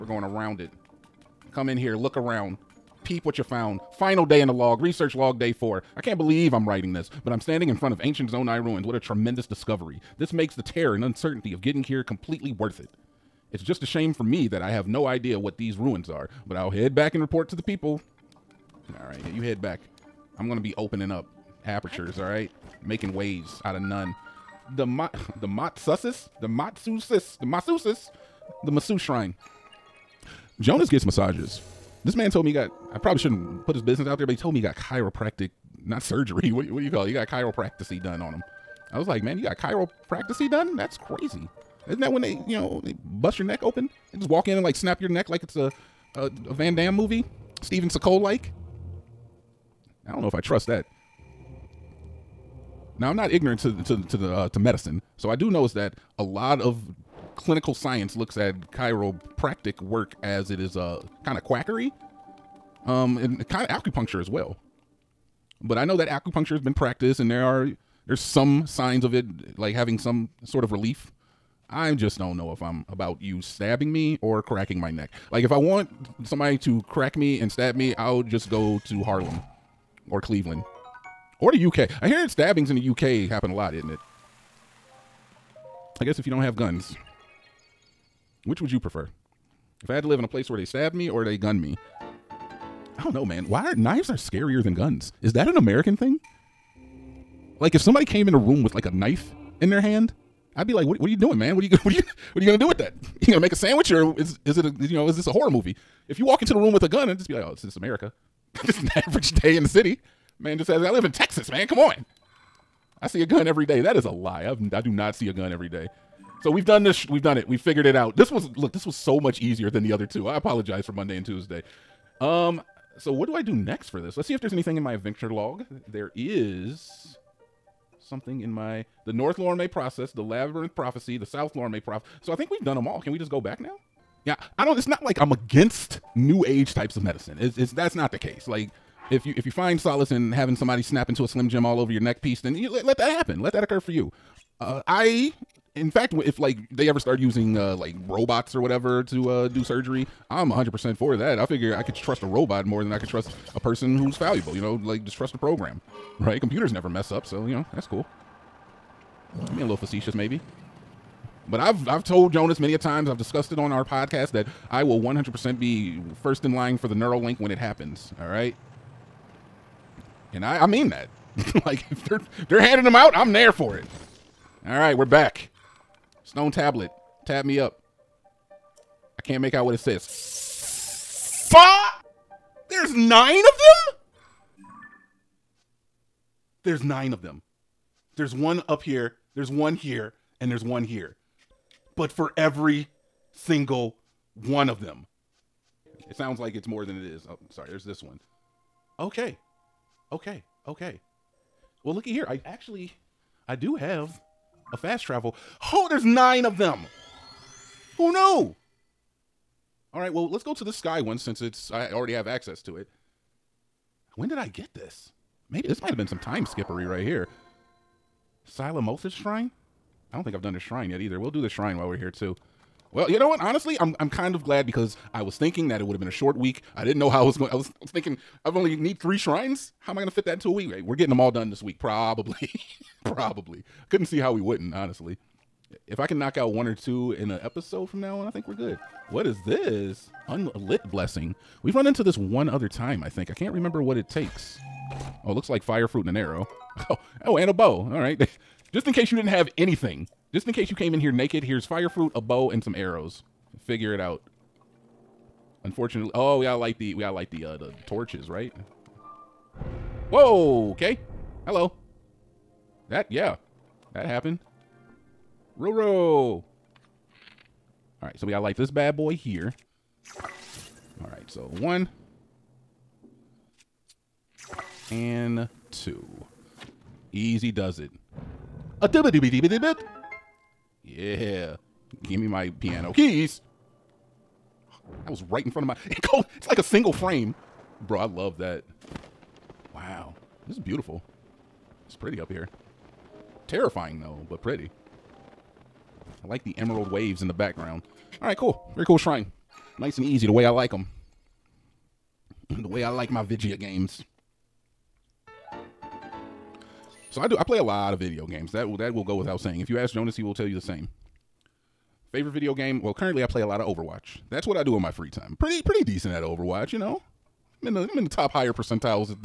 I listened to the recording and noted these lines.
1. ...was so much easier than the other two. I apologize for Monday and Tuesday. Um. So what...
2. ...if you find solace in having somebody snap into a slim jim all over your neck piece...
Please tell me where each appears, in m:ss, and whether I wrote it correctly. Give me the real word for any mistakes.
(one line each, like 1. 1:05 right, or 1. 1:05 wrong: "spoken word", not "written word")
1. 1:58 right
2. 2:19 right.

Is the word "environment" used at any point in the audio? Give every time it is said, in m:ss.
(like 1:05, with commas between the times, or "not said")
not said.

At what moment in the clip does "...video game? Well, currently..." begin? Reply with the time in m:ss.
5:12.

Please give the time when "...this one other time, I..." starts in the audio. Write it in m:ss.
4:02.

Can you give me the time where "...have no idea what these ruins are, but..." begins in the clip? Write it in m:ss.
0:14.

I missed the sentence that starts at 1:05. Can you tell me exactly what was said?
But I know that acupuncture has been practiced, and there are there's some signs of it, like having some sort of relief.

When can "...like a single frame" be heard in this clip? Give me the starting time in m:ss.
4:46.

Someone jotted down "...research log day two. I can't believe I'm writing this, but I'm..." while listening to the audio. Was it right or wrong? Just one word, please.
wrong.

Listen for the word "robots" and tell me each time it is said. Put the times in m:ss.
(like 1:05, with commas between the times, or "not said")
2:28, 2:32.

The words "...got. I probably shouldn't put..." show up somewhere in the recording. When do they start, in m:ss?
0:32.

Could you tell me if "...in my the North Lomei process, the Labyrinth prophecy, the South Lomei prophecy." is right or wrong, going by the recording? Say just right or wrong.
right.